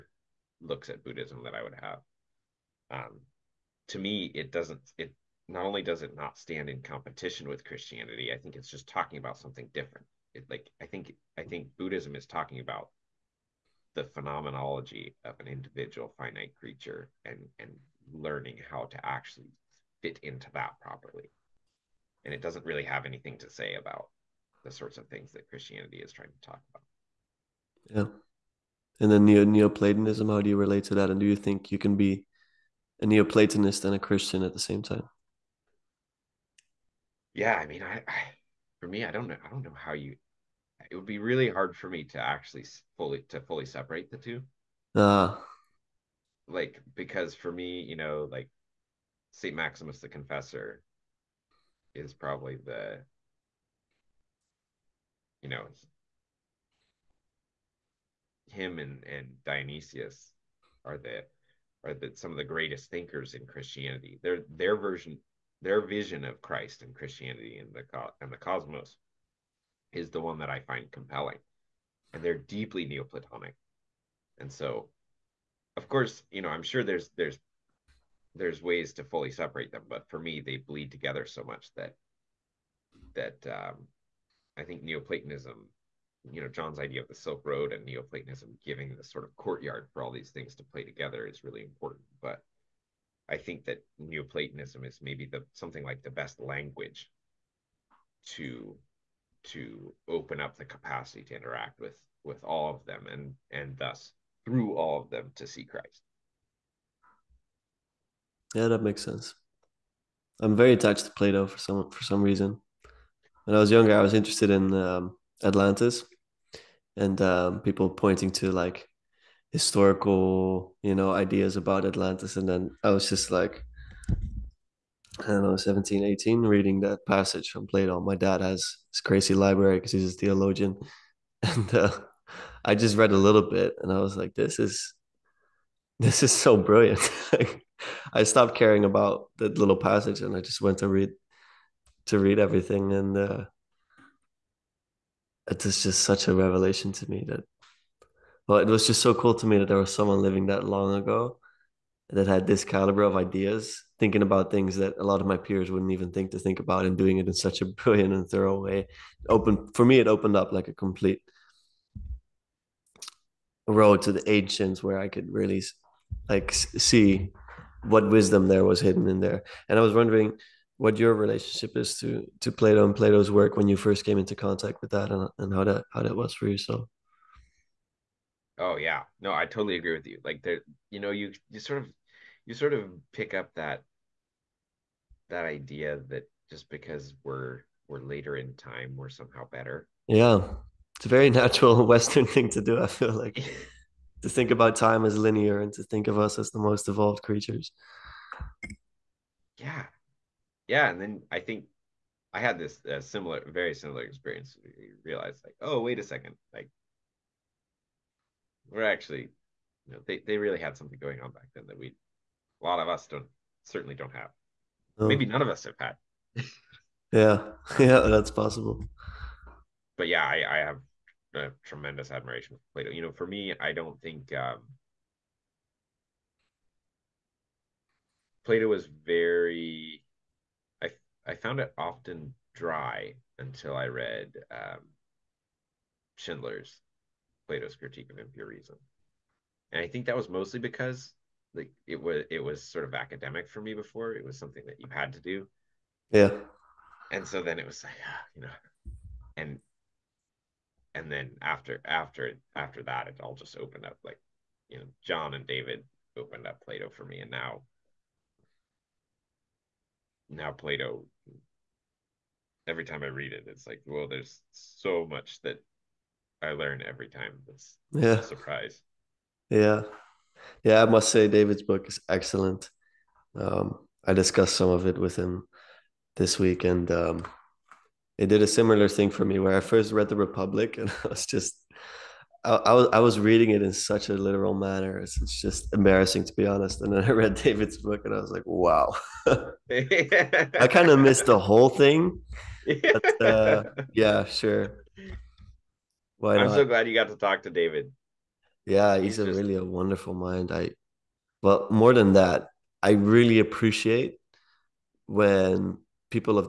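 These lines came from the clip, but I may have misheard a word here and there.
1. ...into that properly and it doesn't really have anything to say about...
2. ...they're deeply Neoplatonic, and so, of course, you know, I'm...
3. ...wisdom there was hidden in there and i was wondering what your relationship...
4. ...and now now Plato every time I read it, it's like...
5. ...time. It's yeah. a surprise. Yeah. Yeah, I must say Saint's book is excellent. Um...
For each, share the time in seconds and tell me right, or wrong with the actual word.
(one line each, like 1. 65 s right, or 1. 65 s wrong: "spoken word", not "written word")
1. 20 s right
2. 72 s right
3. 168 s right
4. 257 s right
5. 267 s wrong: "David", not "Saint".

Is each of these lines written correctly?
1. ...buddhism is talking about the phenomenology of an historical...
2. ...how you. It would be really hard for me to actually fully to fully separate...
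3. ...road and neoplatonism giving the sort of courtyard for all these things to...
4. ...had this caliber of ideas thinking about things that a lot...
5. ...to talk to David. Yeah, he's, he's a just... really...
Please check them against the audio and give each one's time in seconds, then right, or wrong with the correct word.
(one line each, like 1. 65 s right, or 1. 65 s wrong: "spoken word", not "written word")
1. 11 s wrong: "individual", not "historical"
2. 39 s right
3. 87 s right
4. 152 s right
5. 297 s right.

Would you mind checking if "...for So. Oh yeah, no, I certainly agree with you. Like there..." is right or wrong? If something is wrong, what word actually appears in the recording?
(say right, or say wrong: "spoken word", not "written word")
wrong: "totally", not "certainly".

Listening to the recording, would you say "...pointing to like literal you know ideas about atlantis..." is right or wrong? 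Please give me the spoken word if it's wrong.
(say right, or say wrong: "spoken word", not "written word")
wrong: "historical", not "literal".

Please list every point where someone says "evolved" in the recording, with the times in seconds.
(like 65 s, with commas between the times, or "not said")
196 s.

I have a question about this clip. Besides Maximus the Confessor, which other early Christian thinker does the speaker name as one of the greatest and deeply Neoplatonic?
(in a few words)
Dionysius.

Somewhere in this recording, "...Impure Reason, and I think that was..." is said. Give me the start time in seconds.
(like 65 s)
238 s.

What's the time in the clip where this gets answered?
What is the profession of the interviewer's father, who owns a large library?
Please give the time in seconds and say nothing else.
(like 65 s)
130 s.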